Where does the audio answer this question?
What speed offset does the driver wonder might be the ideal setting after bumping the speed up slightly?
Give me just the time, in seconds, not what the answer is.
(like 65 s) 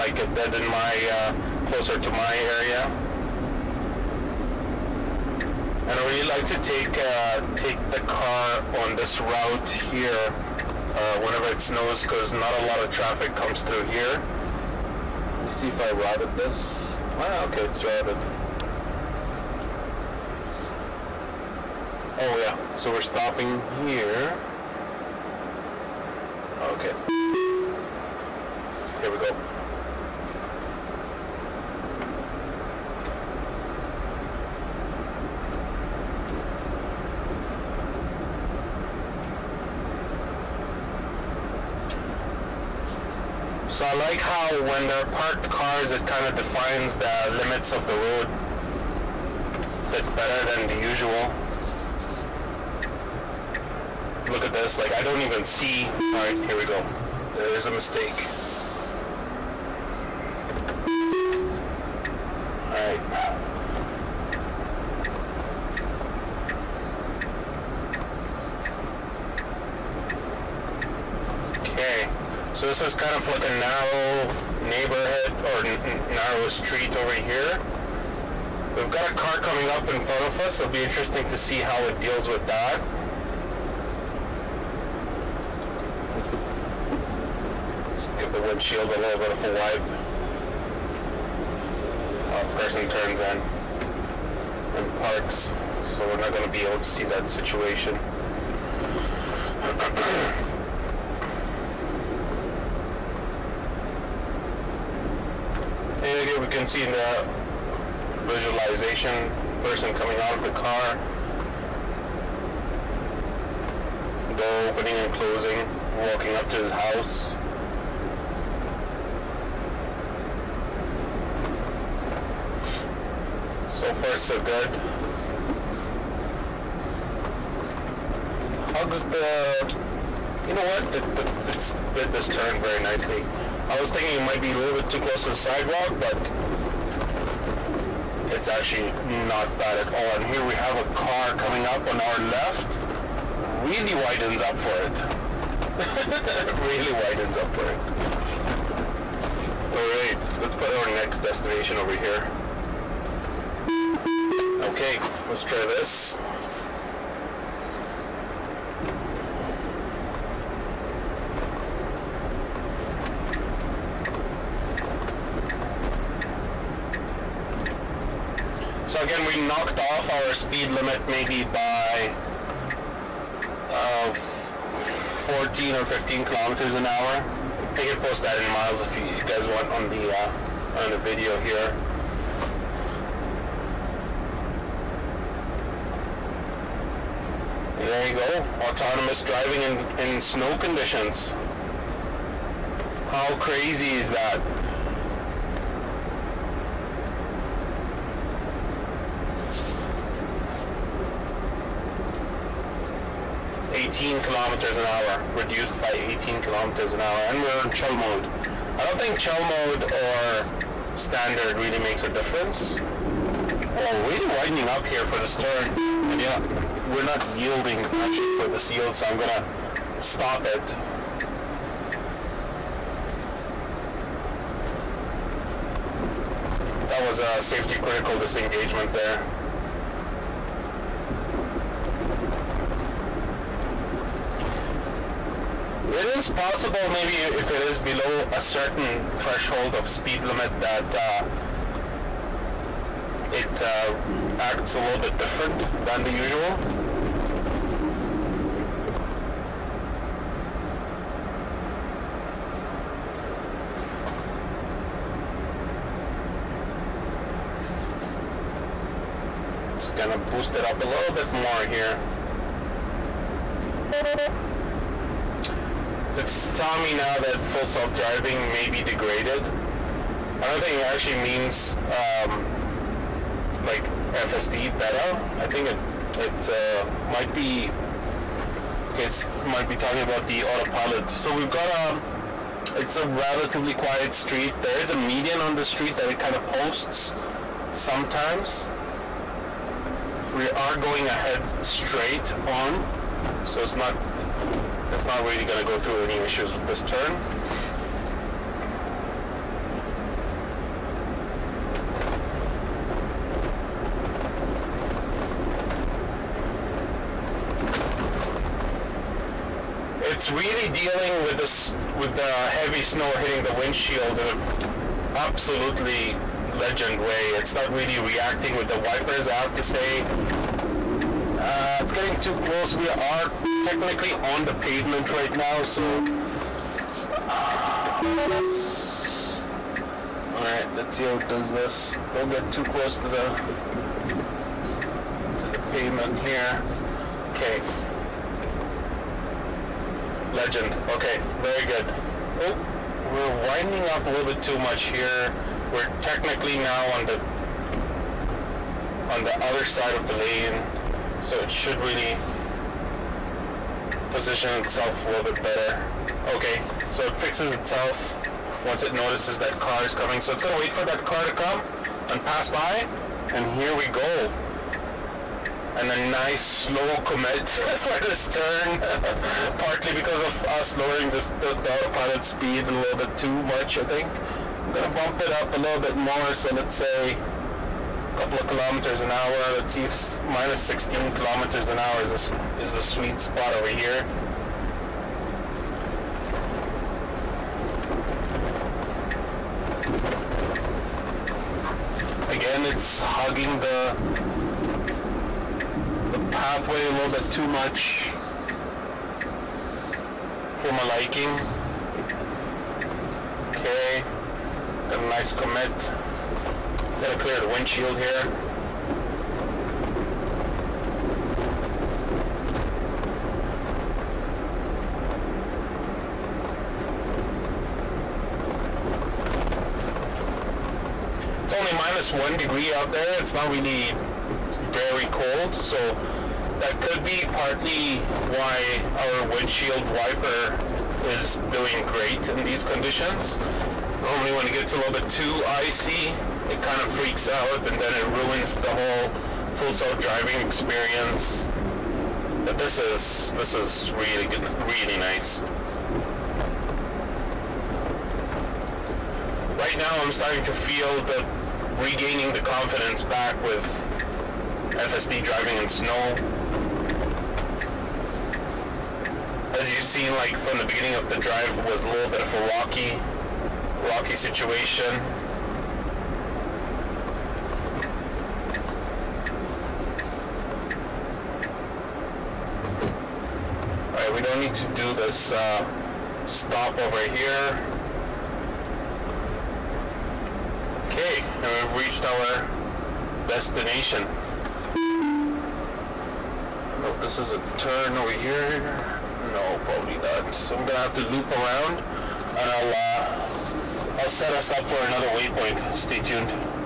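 380 s.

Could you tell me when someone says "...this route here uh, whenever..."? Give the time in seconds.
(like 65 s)
8 s.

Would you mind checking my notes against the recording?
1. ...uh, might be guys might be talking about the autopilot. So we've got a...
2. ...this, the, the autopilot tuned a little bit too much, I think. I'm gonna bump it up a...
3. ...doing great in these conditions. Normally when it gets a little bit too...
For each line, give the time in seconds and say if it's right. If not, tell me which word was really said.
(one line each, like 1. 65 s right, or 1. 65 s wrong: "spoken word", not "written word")
1. 276 s right
2. 371 s wrong: "speed", not "tuned"
3. 431 s right.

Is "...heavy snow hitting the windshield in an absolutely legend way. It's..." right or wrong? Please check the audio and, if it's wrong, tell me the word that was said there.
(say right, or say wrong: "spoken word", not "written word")
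right.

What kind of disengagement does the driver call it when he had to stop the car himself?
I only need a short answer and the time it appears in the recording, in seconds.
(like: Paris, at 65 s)
safety critical, at 227 s.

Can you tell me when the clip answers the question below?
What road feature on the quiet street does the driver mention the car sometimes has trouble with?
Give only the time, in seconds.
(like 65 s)
284 s.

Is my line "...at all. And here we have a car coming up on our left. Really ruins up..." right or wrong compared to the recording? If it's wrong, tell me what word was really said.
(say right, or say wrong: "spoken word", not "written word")
wrong: "widens", not "ruins".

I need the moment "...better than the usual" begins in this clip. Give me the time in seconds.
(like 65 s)
50 s.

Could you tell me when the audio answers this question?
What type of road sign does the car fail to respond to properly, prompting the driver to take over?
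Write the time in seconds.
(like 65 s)
218 s.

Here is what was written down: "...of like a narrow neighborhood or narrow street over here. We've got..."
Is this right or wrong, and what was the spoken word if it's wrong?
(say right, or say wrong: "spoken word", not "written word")
right.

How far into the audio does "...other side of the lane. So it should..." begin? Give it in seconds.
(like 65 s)
349 s.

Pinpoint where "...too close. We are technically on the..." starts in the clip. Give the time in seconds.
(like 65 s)
322 s.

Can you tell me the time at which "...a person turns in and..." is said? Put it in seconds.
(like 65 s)
92 s.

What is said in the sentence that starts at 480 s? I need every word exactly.
Okay, and we've reached our destination.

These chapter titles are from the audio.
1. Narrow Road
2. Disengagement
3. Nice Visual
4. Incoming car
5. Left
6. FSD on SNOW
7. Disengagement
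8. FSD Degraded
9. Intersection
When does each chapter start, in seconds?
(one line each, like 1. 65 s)
1. 11 s
2. 51 s
3. 101 s
4. 141 s
5. 171 s
6. 186 s
7. 211 s
8. 261 s
9. 289 s.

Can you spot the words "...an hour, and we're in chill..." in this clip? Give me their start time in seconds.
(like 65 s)
206 s.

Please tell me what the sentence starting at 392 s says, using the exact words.
Again, it's hugging the the pathway a little bit too much for my liking.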